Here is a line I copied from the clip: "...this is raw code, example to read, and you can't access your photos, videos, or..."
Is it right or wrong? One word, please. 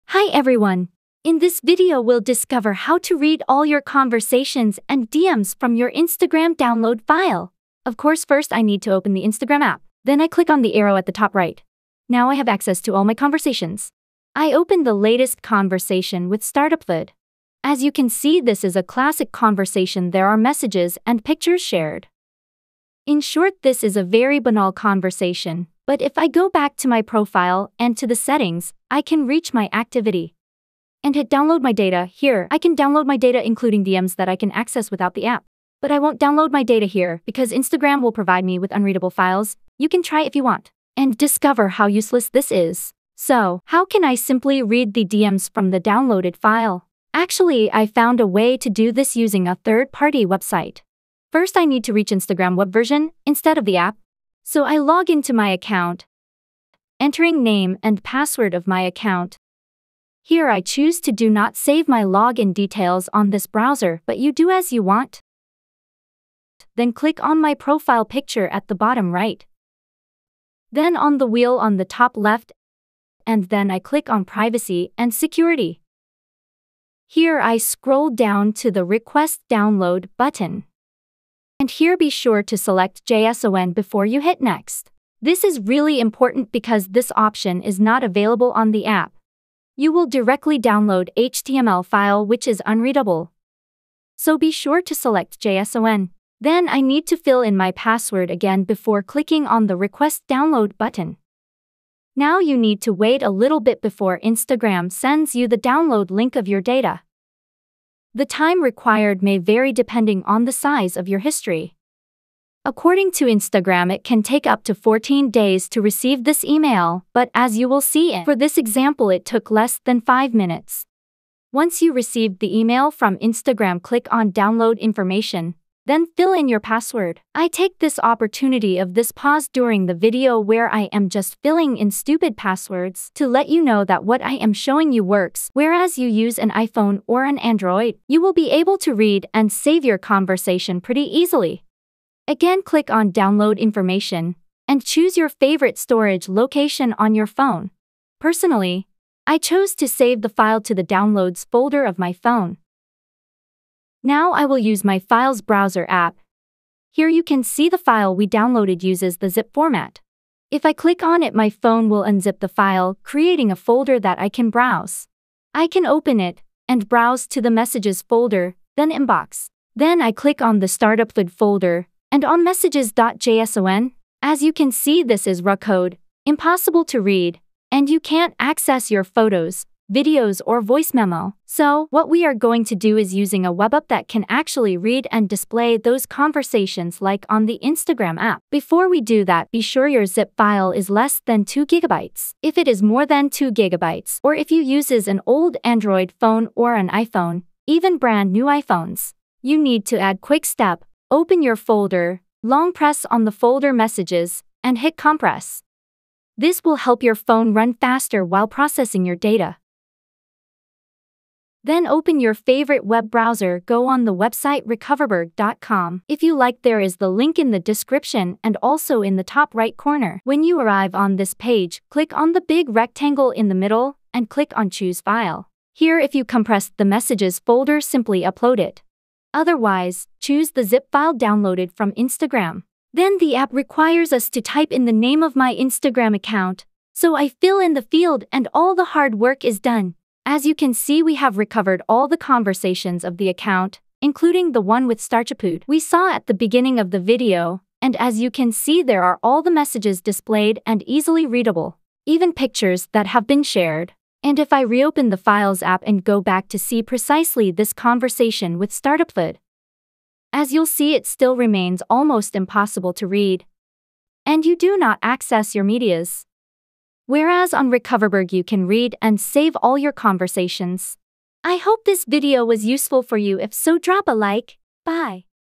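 wrong.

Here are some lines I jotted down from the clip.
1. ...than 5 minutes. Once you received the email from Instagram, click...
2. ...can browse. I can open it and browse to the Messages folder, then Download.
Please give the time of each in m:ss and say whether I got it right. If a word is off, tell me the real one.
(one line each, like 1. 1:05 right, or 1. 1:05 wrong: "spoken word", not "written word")
1. 1:59 right
2. 2:44 wrong: "Inbox", not "Download".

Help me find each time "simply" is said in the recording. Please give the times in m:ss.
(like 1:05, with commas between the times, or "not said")
0:44, 3:47.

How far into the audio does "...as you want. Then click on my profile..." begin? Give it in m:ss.
1:04.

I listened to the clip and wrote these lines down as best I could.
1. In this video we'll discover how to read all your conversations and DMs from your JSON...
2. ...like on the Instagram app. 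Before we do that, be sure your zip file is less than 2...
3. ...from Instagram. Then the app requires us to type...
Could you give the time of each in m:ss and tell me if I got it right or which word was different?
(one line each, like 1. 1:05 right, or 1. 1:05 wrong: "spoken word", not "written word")
1. 0:01 wrong: "Instagram", not "JSON"
2. 3:07 right
3. 3:51 right.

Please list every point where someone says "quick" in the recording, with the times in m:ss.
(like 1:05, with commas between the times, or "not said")
3:20.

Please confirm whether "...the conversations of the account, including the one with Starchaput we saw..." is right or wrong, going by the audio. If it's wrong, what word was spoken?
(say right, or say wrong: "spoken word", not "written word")
right.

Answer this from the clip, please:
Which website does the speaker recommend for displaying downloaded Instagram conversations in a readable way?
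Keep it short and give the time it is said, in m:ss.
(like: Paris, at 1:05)
recoverberg.com, at 3:34.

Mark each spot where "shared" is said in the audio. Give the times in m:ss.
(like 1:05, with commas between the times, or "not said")
0:21, 4:13.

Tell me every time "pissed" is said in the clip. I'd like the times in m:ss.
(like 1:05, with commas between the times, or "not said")
not said.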